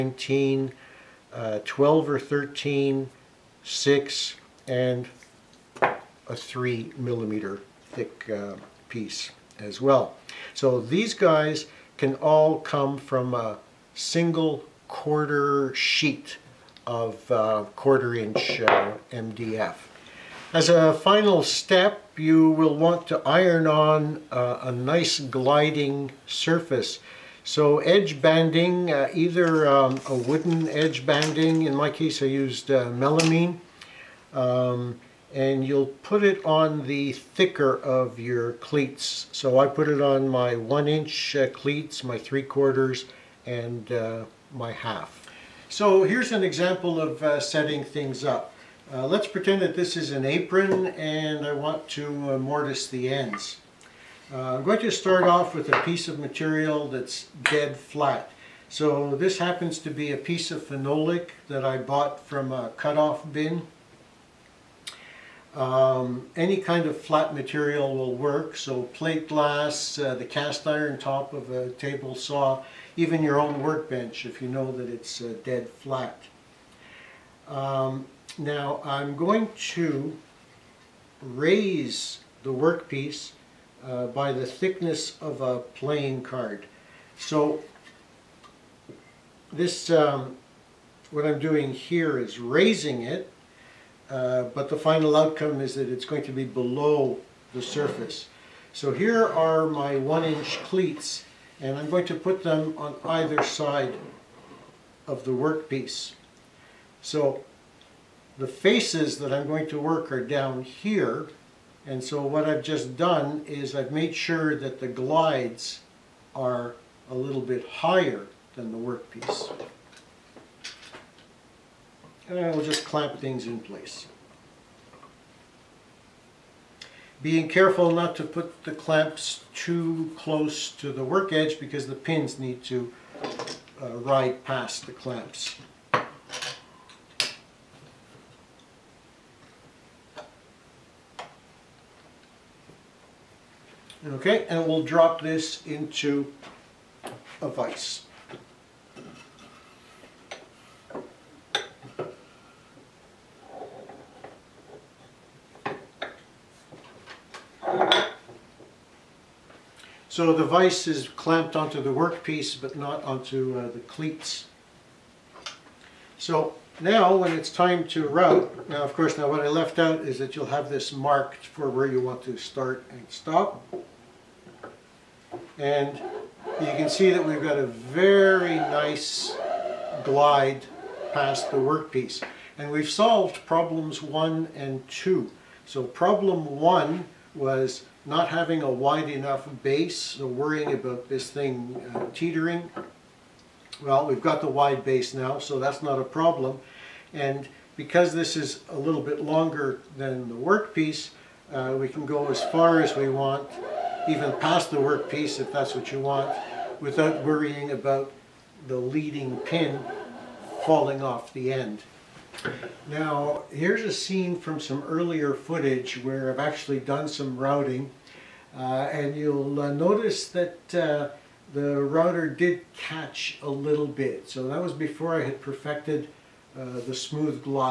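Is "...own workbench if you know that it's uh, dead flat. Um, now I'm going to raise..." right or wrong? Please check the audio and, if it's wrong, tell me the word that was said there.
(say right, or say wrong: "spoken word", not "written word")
right.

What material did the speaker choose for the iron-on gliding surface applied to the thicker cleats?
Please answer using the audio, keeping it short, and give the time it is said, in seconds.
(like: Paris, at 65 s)
melamine, at 32 s.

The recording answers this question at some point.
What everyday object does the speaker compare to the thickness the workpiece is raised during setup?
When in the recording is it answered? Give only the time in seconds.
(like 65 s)
85 s.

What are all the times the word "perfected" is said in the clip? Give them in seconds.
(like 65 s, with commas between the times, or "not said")
225 s.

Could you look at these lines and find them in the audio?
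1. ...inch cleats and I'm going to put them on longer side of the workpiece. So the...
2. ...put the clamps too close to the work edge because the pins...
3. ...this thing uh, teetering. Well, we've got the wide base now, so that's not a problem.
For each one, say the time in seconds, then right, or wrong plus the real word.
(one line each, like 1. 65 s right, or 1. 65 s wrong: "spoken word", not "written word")
1. 100 s wrong: "either", not "longer"
2. 128 s right
3. 191 s right.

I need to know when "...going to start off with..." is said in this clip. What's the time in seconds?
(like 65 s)
54 s.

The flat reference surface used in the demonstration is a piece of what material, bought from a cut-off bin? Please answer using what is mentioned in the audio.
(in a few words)
phenolic.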